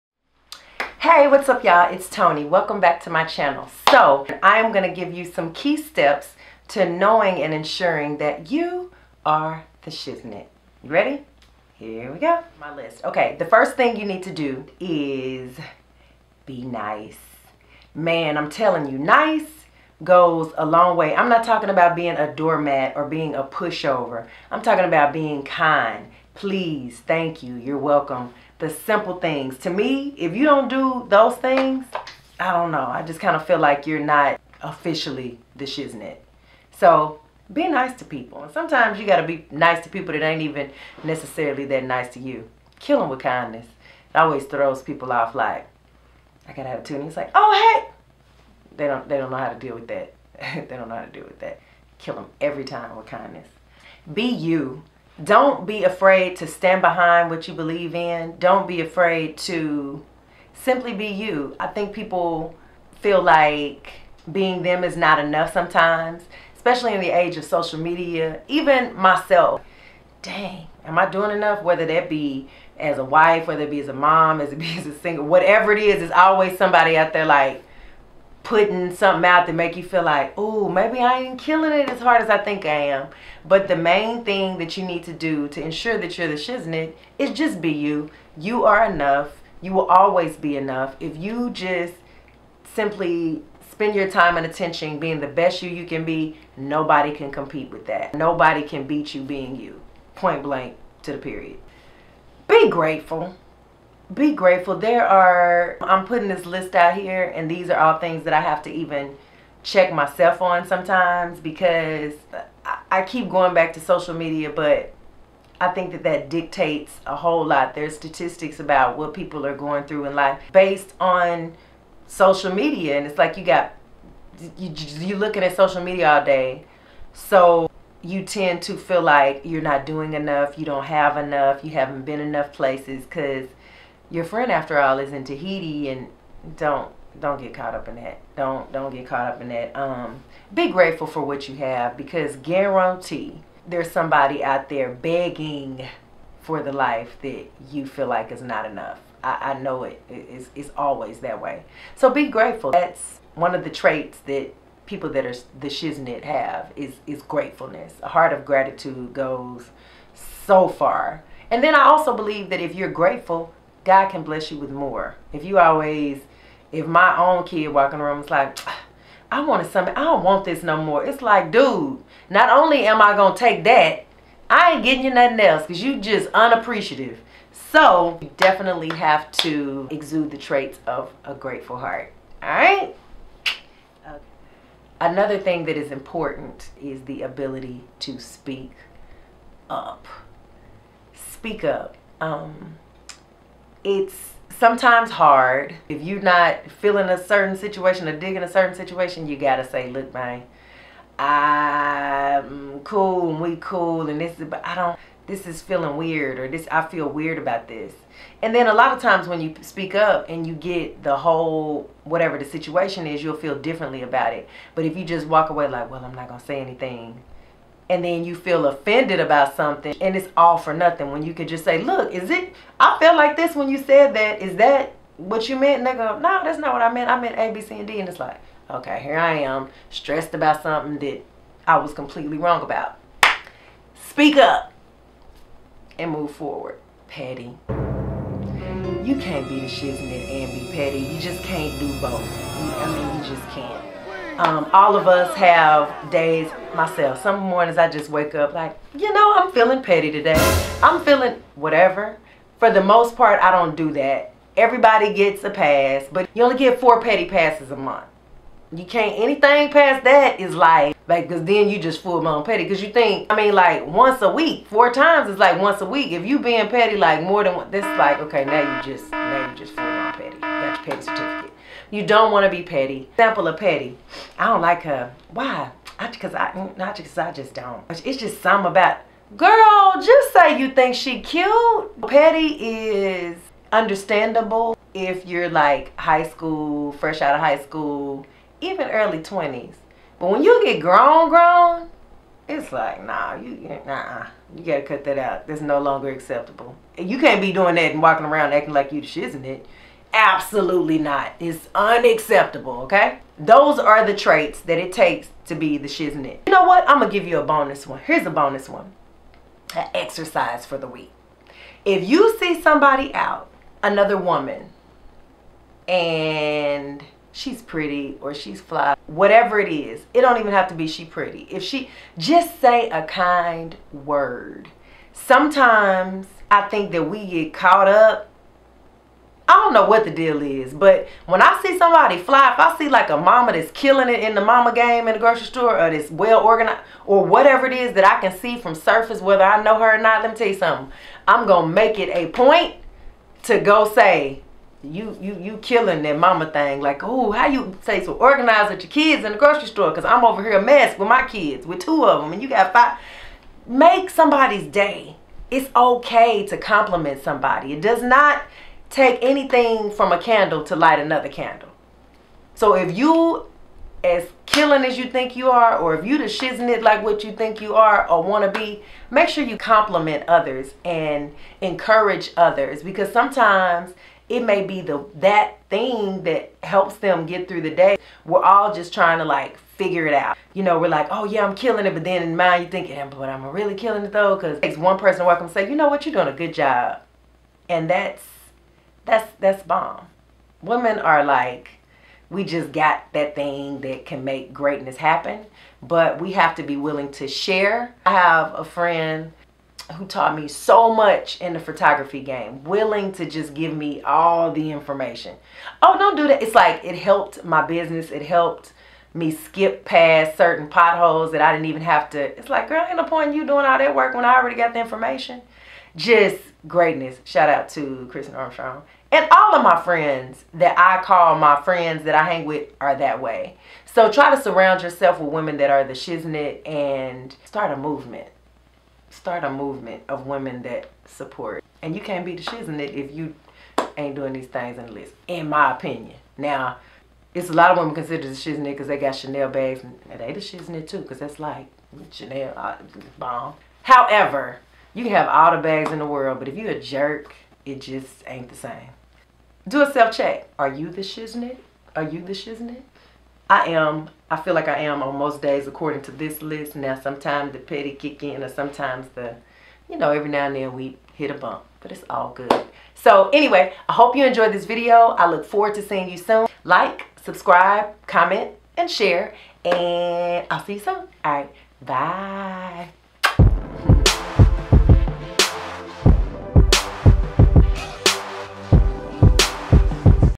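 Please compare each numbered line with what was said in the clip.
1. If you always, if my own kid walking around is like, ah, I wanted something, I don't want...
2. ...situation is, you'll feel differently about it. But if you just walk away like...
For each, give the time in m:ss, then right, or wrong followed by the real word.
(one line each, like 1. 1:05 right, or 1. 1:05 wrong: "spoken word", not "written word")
1. 2:45 right
2. 3:32 right.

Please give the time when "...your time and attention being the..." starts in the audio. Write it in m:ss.
1:33.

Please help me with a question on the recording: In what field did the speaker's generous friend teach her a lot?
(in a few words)
photography.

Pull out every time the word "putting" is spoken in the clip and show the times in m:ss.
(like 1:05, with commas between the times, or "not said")
1:18, 1:46.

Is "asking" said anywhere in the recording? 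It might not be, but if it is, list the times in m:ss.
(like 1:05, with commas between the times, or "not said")
not said.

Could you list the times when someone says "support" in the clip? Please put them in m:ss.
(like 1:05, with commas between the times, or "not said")
7:11.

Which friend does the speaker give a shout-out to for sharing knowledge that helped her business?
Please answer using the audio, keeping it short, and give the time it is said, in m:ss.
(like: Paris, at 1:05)
Christin Armstrong, at 6:58.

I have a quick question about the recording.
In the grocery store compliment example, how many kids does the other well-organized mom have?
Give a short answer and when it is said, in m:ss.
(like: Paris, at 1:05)
5, at 5:52.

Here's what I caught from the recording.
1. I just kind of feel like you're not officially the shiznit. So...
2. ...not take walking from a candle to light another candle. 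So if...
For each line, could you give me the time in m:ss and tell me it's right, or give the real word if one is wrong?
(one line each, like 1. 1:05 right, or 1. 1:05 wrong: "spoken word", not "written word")
1. 0:32 right
2. 5:58 wrong: "anything", not "walking".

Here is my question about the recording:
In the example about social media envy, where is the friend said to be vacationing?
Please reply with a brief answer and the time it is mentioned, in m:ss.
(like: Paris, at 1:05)
Tahiti, at 2:15.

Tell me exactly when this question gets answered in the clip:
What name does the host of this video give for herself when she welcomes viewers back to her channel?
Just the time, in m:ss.
0:02.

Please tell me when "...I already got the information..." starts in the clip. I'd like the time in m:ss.
6:54.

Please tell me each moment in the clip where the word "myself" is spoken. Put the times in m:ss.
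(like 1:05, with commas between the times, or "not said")
1:08, 1:49, 4:06.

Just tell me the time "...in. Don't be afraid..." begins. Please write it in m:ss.
0:57.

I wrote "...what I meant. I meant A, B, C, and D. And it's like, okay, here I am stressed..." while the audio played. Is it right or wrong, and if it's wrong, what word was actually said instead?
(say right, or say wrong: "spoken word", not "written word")
right.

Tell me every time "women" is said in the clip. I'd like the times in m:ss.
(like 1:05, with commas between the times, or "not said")
6:30, 7:05, 7:10, 7:17.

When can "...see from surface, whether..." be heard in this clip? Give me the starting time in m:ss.
5:38.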